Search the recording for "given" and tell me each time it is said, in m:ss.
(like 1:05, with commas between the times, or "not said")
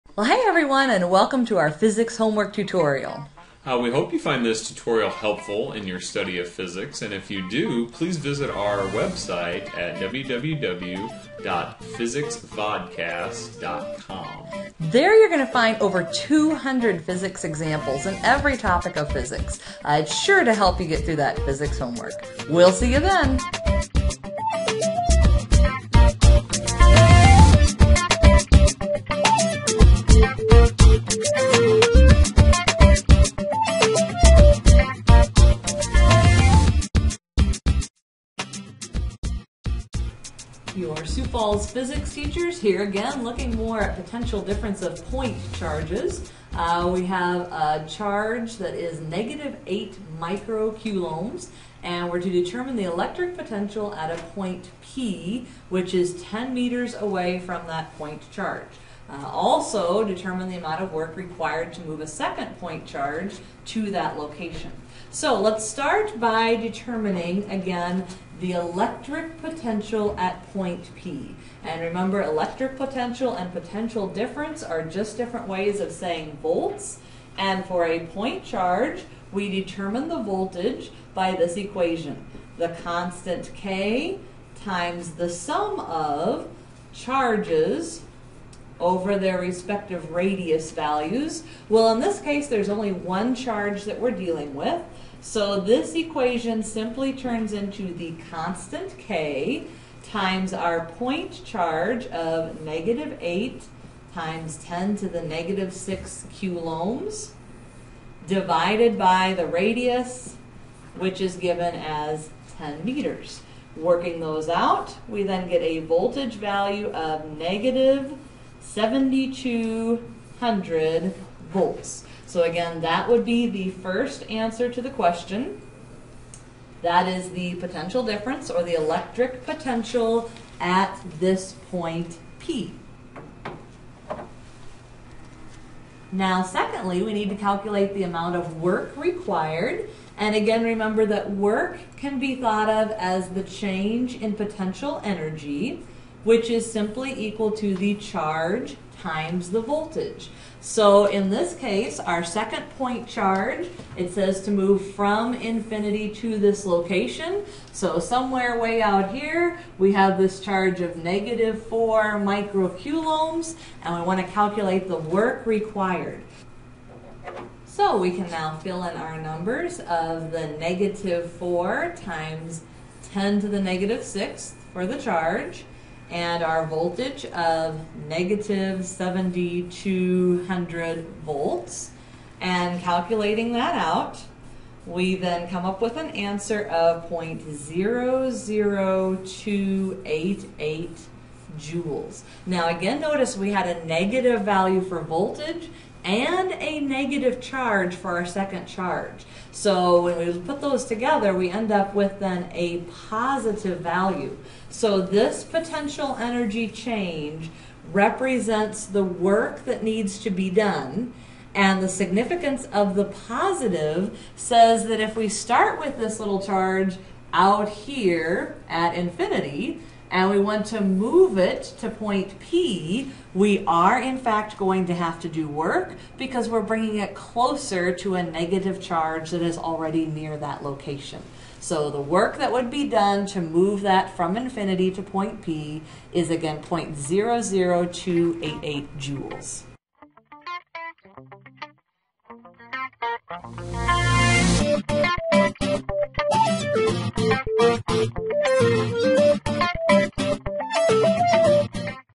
1:51.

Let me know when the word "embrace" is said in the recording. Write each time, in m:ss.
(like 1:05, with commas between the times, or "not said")
not said.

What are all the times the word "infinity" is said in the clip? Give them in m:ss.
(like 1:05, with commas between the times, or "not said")
2:35, 3:38, 3:54.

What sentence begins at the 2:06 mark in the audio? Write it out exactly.
That is the potential difference or the electric potential at this point P.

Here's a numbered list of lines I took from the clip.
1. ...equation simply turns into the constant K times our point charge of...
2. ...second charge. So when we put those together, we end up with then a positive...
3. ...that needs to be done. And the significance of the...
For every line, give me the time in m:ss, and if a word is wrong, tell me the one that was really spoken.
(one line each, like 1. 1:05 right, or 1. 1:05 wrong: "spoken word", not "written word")
1. 1:35 right
2. 3:18 right
3. 3:29 right.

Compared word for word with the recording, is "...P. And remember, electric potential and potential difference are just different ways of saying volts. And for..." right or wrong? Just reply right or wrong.
right.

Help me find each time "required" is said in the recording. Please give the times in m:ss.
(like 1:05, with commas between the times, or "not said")
1:01, 2:18, 2:45.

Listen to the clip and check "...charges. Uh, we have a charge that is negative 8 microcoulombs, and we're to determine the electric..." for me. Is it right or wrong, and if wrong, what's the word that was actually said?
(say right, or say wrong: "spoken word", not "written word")
right.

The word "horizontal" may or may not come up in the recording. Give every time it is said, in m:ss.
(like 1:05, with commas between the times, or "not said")
not said.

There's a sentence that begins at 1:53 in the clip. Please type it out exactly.
Working those out, we then get a voltage value of negative negative.